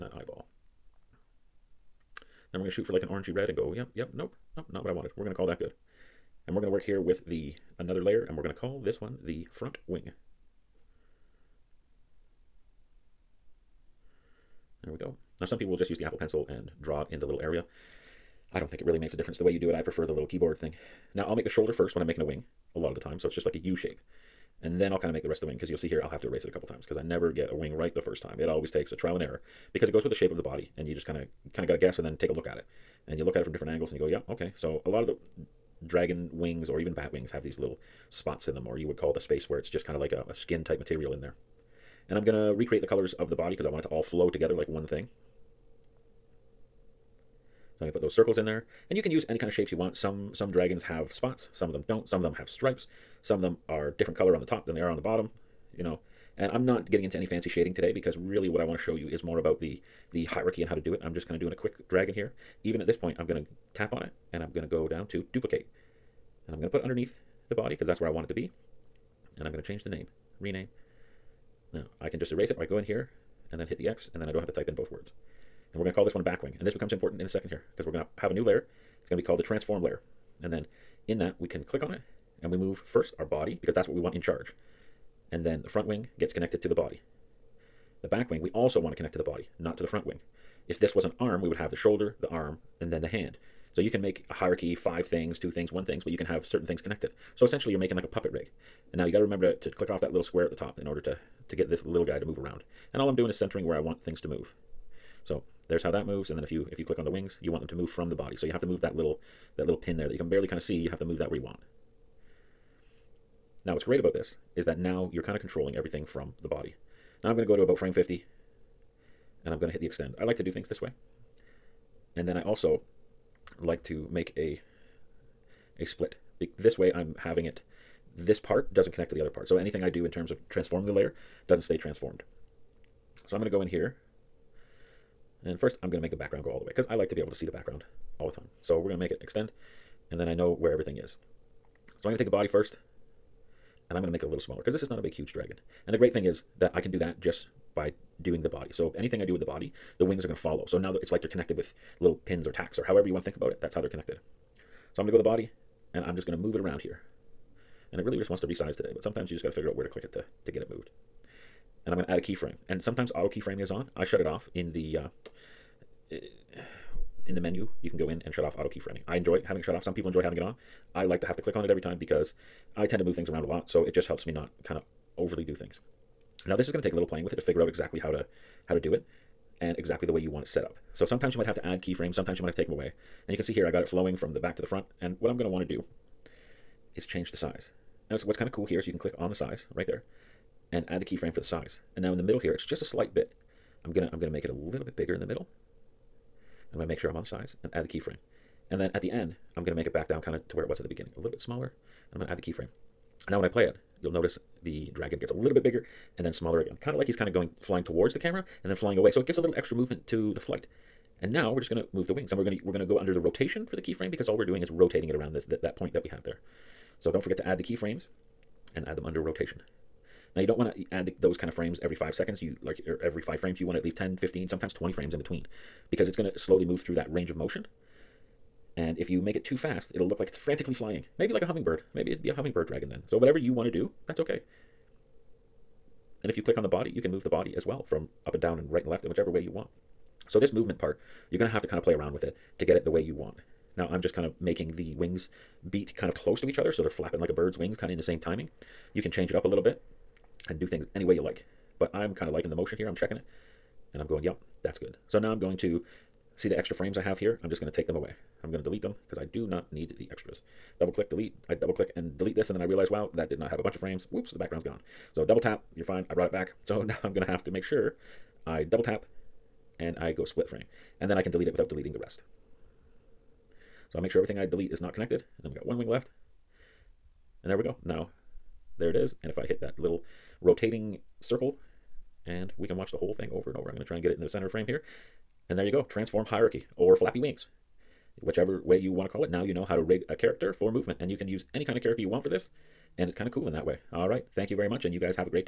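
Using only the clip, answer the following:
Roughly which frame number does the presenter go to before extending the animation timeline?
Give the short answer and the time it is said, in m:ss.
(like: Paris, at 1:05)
50, at 1:57.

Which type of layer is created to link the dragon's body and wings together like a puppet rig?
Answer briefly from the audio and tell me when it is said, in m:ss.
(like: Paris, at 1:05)
transform layer, at 1:19.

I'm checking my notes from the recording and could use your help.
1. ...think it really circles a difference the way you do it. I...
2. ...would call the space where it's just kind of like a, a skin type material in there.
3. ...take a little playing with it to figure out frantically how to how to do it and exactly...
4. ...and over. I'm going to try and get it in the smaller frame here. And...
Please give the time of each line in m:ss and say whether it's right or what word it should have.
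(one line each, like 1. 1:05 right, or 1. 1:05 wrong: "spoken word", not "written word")
1. 0:18 wrong: "makes", not "circles"
2. 0:38 right
3. 2:56 wrong: "exactly", not "frantically"
4. 4:43 wrong: "center", not "smaller".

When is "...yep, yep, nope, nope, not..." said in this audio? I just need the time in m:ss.
0:03.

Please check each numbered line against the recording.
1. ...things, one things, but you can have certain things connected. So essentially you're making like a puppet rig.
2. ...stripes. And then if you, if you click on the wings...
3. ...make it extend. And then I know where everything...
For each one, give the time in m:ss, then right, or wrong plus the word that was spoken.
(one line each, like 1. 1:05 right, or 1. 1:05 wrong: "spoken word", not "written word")
1. 1:35 right
2. 1:46 wrong: "moves", not "stripes"
3. 2:18 right.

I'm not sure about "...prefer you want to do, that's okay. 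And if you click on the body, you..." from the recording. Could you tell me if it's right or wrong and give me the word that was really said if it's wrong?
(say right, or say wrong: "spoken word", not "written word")
wrong: "whatever", not "prefer".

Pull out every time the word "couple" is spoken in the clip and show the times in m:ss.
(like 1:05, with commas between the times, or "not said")
0:26.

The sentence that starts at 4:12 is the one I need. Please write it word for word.
I'm checking it and I'm going, yep, that's good.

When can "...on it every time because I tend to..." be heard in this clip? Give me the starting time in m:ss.
2:51.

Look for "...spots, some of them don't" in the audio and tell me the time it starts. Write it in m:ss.
0:51.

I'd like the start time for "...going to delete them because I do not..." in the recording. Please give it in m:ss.
4:18.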